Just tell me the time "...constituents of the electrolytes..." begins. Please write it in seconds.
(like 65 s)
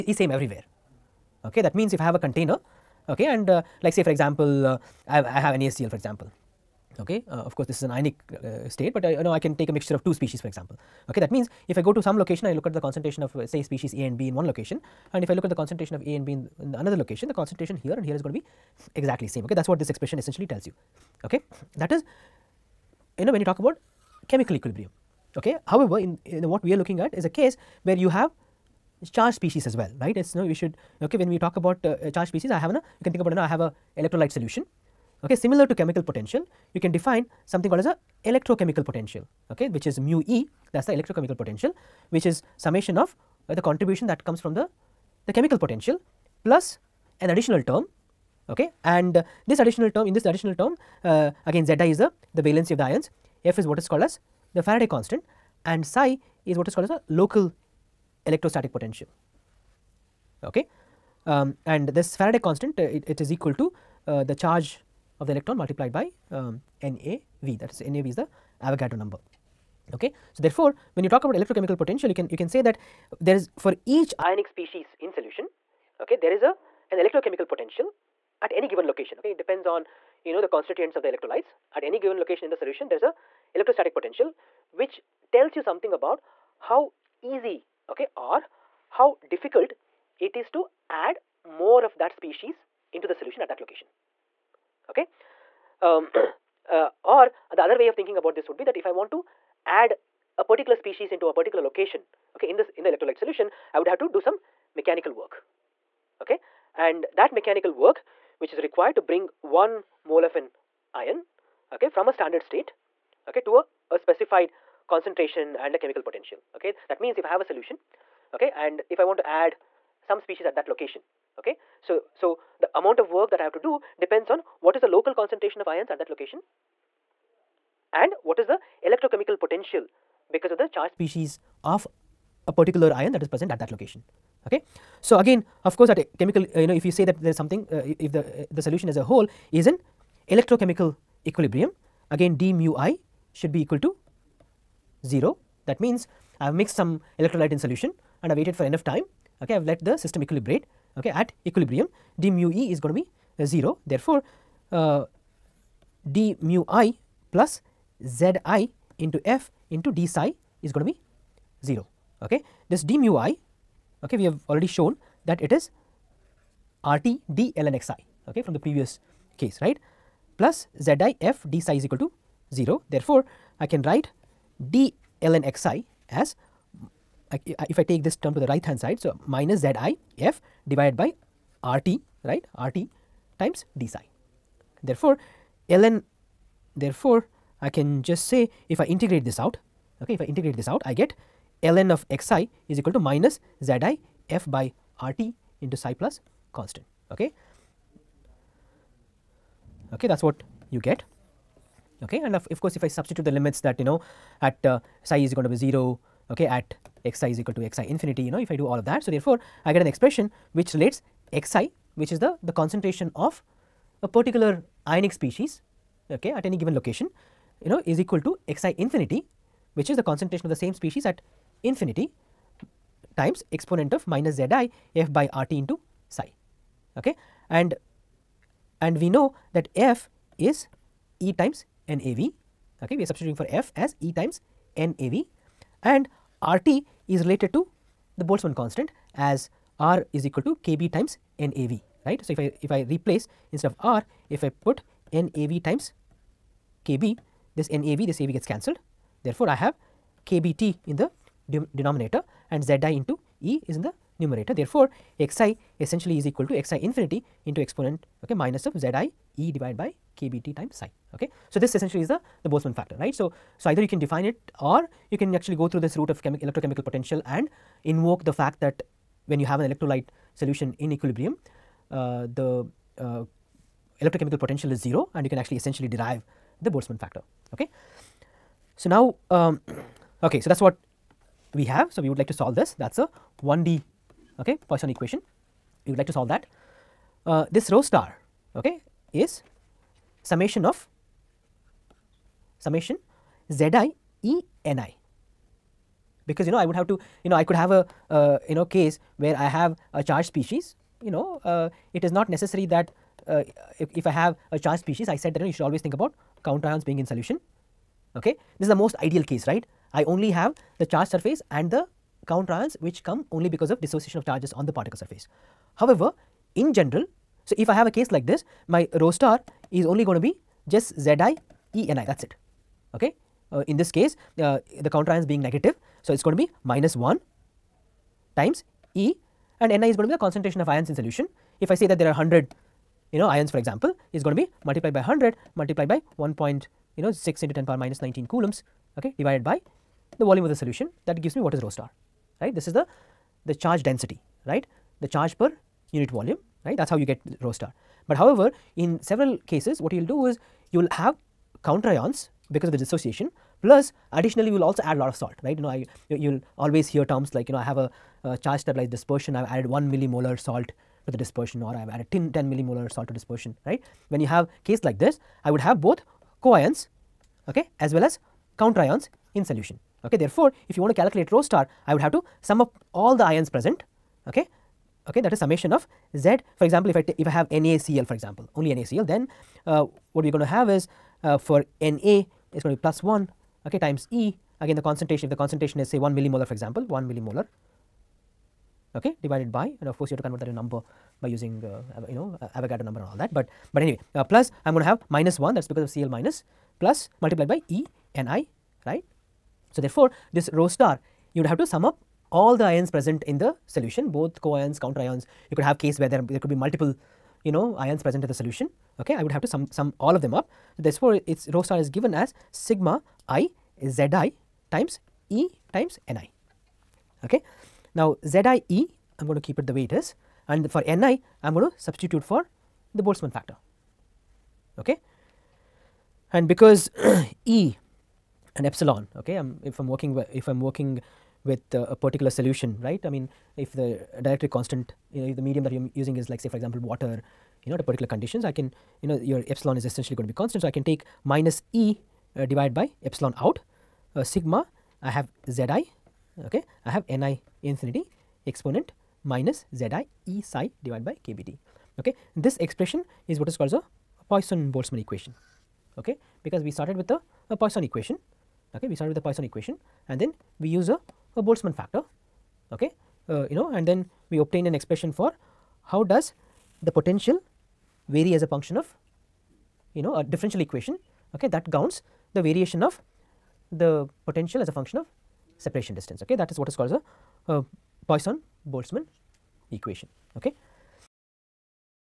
80 s.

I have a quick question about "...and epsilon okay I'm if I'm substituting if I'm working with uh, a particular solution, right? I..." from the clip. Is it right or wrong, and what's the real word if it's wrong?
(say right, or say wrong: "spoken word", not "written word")
wrong: "working", not "substituting".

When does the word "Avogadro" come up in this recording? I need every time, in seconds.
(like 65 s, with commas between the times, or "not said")
68 s, 392 s.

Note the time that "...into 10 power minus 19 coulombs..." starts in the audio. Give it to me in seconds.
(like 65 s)
337 s.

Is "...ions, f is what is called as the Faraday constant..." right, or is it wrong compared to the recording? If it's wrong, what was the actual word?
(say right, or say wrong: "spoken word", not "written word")
right.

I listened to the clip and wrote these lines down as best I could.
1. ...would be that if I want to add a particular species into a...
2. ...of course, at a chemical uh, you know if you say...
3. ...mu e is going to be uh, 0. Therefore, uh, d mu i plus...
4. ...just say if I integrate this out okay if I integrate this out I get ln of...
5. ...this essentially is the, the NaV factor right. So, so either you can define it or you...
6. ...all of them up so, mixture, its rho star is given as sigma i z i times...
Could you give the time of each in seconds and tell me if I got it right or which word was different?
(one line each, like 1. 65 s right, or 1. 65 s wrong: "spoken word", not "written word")
1. 98 s right
2. 135 s right
3. 152 s right
4. 188 s right
5. 261 s wrong: "Boltzmann", not "NaV"
6. 409 s wrong: "therefore", not "mixture".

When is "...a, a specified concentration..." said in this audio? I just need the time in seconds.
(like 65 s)
113 s.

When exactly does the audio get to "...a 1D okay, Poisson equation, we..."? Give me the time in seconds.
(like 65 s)
282 s.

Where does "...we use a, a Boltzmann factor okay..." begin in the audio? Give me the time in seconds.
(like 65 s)
460 s.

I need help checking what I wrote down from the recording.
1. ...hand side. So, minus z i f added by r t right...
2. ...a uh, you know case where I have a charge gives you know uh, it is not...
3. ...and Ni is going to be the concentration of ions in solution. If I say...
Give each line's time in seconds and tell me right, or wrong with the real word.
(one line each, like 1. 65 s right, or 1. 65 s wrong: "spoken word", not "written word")
1. 178 s wrong: "divided", not "added"
2. 297 s wrong: "species", not "gives"
3. 329 s right.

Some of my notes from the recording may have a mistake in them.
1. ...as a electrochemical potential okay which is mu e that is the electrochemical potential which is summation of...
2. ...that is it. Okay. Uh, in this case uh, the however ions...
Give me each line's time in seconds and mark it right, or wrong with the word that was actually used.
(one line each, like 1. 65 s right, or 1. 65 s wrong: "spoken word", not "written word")
1. 37 s right
2. 322 s wrong: "counter", not "however".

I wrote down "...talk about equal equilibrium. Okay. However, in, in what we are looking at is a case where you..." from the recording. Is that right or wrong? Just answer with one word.
wrong.